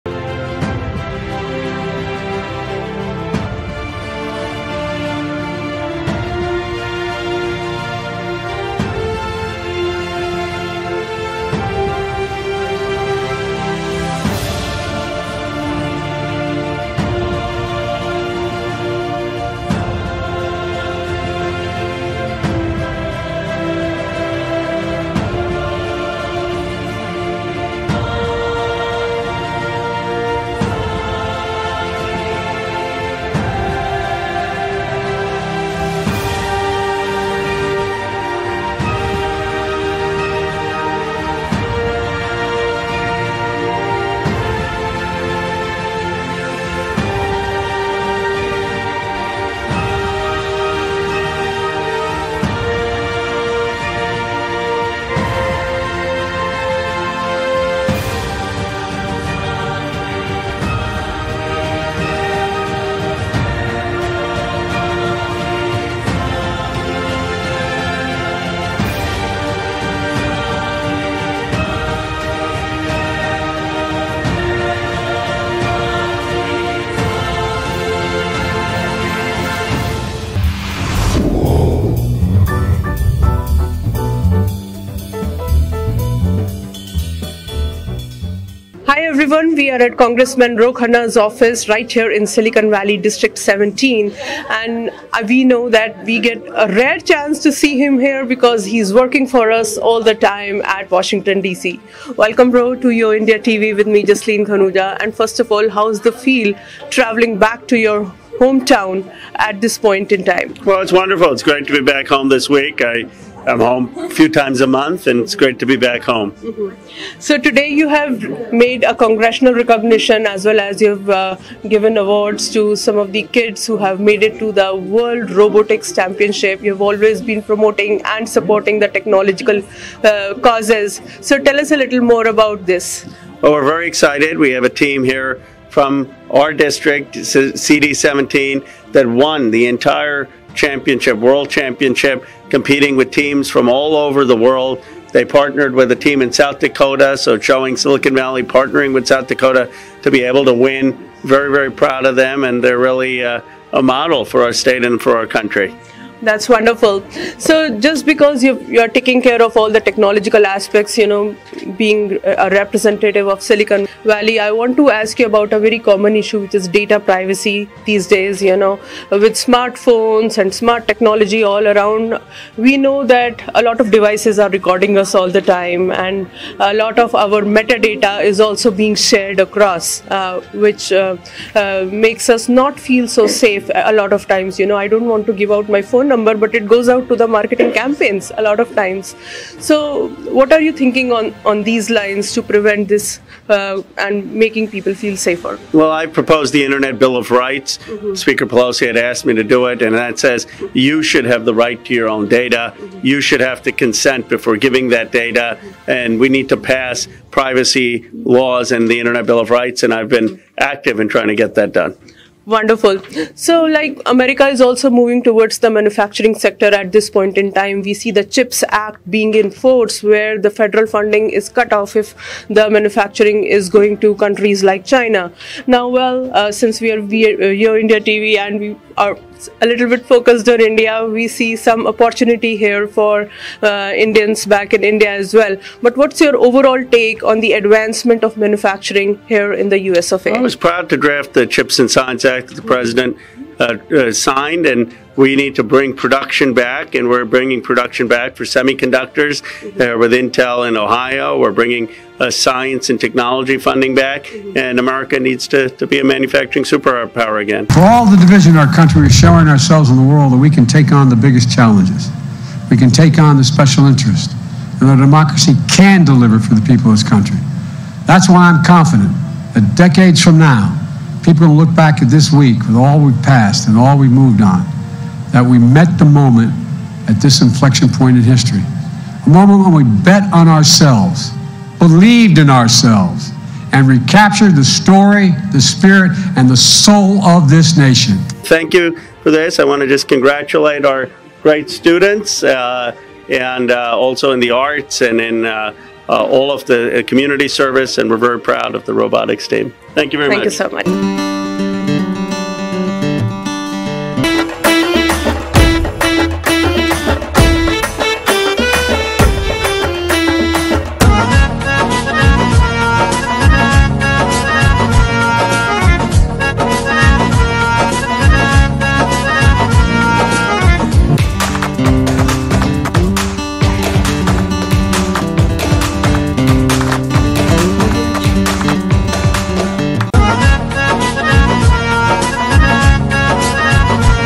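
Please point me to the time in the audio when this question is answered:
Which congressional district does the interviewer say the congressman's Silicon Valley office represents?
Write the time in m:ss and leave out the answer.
1:32.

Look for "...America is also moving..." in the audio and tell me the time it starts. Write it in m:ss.
3:34.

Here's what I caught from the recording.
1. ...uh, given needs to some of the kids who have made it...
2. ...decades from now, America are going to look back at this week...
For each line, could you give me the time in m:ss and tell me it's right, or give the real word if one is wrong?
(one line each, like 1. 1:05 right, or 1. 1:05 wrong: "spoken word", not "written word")
1. 2:01 wrong: "awards", not "needs"
2. 4:29 wrong: "People", not "America".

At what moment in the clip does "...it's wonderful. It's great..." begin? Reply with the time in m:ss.
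1:50.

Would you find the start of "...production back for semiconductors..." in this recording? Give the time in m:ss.
4:07.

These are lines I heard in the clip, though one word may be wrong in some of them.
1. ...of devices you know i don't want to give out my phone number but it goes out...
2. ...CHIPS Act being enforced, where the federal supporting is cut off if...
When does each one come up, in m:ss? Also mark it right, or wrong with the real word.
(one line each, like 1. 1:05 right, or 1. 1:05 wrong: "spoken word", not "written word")
1. 3:04 wrong: "times", not "devices"
2. 3:38 wrong: "funding", not "supporting".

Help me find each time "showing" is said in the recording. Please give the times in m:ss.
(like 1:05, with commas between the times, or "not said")
2:27, 4:19.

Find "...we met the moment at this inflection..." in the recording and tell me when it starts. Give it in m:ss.
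4:35.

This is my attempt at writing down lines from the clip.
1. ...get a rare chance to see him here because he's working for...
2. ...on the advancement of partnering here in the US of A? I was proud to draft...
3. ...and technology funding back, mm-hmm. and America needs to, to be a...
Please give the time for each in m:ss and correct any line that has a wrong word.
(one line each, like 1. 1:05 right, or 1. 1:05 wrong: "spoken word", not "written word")
1. 1:36 right
2. 3:57 wrong: "manufacturing", not "partnering"
3. 4:12 right.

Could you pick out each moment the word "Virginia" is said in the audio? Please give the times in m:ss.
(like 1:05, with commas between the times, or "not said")
not said.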